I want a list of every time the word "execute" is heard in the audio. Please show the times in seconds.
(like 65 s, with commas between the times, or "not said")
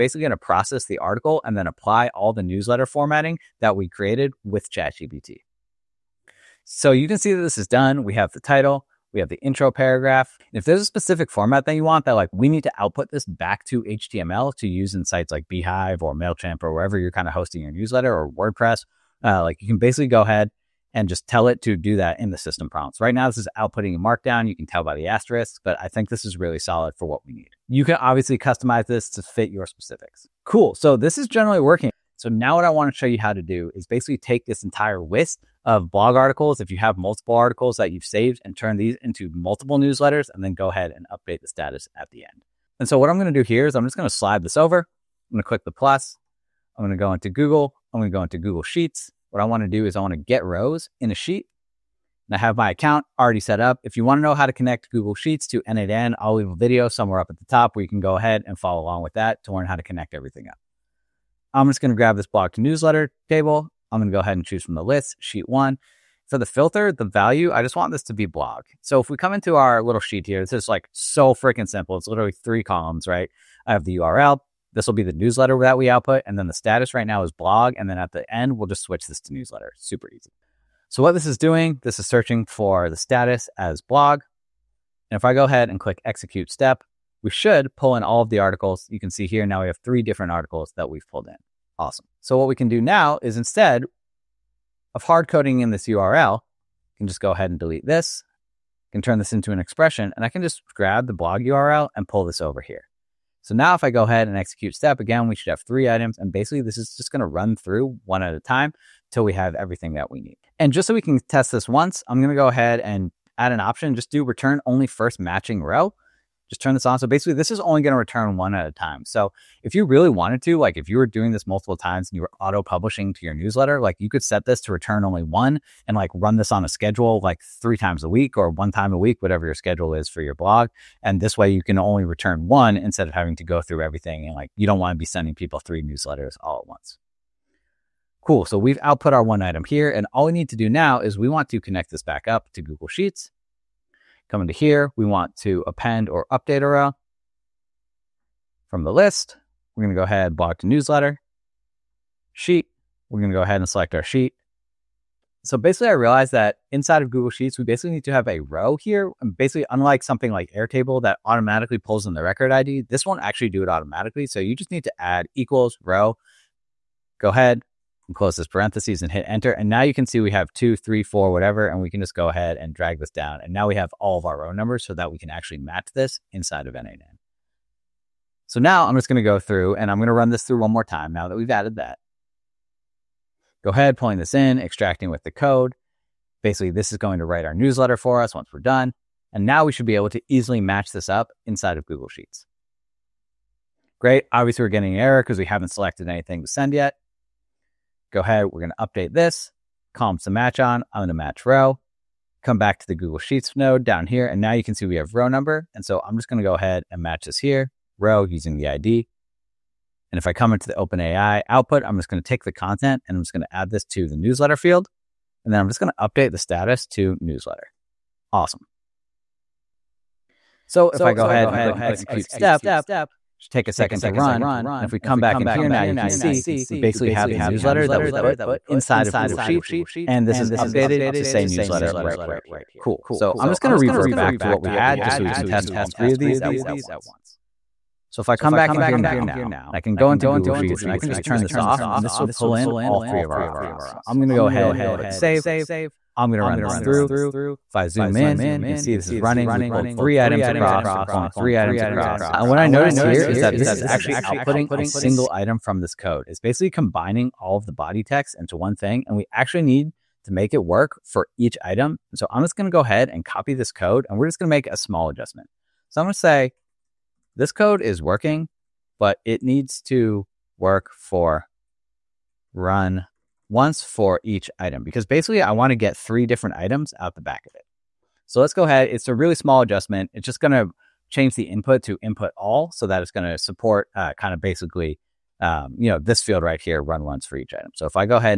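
86 s, 104 s, 221 s.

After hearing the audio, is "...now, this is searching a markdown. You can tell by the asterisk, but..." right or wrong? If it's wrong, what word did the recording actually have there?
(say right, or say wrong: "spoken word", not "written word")
wrong: "outputting", not "searching".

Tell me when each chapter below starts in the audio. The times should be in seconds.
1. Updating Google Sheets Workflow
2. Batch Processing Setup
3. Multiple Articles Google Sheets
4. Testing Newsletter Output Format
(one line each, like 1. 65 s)
1. 201 s
2. 130 s
3. 42 s
4. 6 s.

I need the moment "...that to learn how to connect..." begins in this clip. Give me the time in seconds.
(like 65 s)
59 s.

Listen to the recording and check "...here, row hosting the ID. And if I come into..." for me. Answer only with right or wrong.
wrong.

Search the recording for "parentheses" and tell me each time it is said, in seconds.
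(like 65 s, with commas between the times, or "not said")
168 s.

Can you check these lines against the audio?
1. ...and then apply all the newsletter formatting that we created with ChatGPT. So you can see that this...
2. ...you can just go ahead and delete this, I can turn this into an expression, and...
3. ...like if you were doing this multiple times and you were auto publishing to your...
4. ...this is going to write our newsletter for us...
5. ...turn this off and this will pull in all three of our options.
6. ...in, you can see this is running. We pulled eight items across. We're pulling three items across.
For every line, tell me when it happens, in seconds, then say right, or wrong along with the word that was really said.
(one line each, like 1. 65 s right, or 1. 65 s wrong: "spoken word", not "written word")
1. 1 s right
2. 96 s right
3. 120 s right
4. 186 s right
5. 241 s right
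6. 248 s wrong: "three", not "eight".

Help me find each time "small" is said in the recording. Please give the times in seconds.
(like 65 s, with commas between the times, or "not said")
264 s, 279 s.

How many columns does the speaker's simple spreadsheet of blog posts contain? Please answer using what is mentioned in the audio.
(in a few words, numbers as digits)
3.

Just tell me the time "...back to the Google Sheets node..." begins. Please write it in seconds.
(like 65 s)
202 s.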